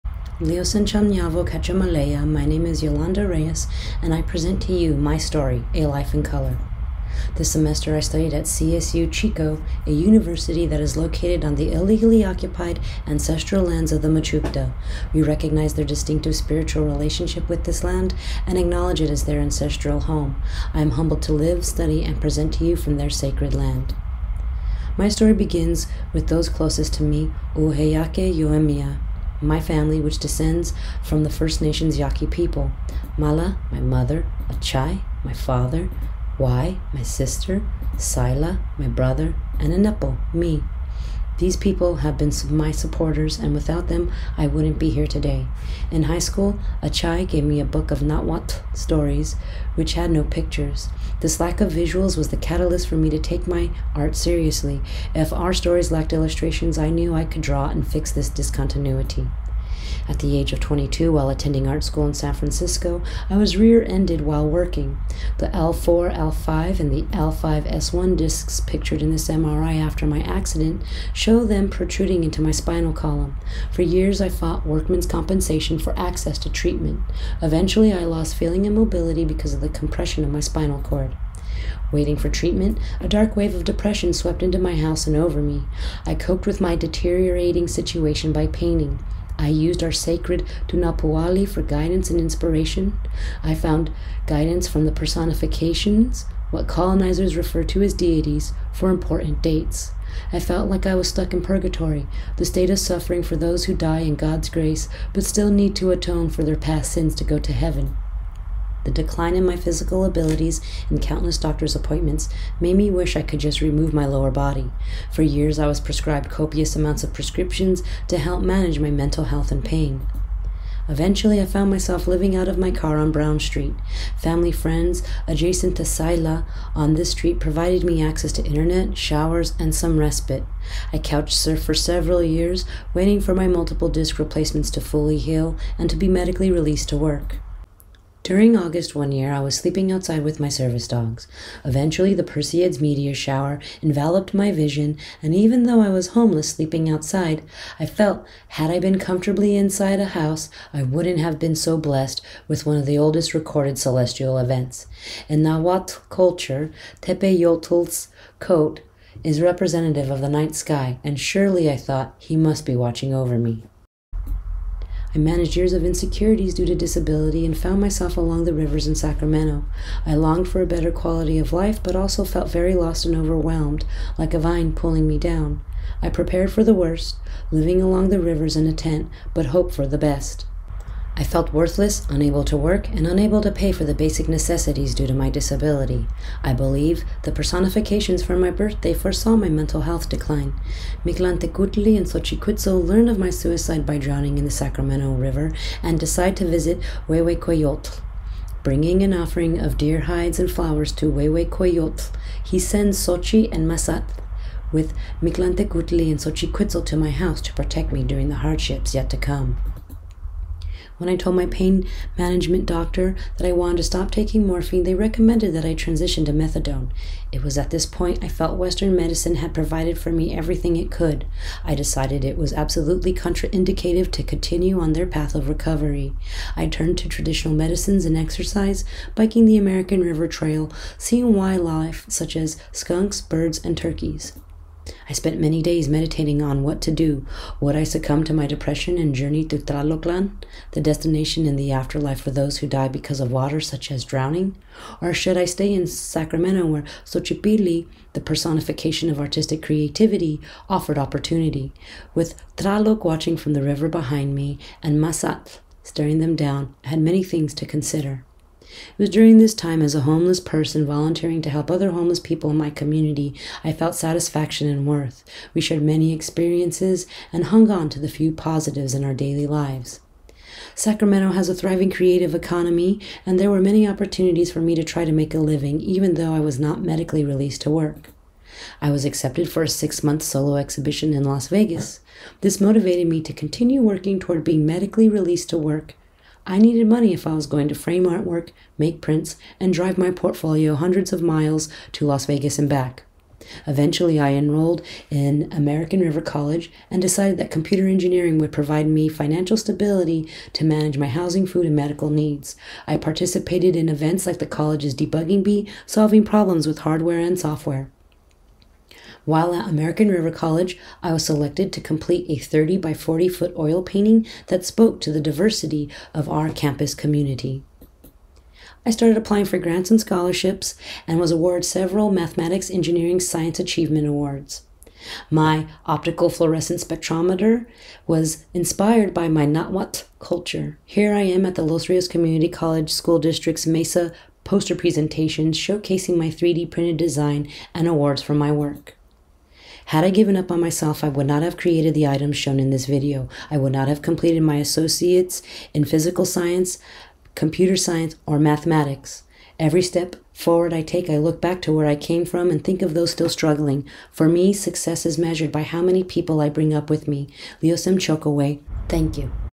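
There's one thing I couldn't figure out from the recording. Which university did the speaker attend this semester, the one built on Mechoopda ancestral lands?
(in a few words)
CSU Chico.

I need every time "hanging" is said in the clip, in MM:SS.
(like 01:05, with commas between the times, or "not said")
not said.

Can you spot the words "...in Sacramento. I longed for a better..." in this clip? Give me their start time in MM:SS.
02:48.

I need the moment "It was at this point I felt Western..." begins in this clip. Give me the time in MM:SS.
03:37.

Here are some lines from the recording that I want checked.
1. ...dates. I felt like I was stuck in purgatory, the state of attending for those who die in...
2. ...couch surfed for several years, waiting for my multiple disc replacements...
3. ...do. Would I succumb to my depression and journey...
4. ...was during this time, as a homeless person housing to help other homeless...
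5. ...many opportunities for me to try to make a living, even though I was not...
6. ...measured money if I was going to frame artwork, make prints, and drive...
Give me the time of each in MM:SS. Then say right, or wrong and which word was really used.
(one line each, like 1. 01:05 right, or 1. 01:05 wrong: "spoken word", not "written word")
1. 01:39 wrong: "suffering", not "attending"
2. 02:10 right
3. 03:56 right
4. 04:19 wrong: "volunteering", not "housing"
5. 04:33 right
6. 04:46 wrong: "needed", not "measured".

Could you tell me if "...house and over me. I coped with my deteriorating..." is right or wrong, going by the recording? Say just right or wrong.
right.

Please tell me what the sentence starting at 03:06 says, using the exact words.
I believe the personifications for my birthday foresaw my mental health decline.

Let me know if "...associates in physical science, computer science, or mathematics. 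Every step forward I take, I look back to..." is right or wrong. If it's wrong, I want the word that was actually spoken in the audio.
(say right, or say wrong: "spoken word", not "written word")
right.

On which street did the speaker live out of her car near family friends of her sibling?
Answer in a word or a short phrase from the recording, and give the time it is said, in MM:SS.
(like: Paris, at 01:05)
Brown Street, at 02:03.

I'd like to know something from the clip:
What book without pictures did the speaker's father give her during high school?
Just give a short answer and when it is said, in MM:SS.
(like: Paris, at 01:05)
Nahuatl stories, at 00:48.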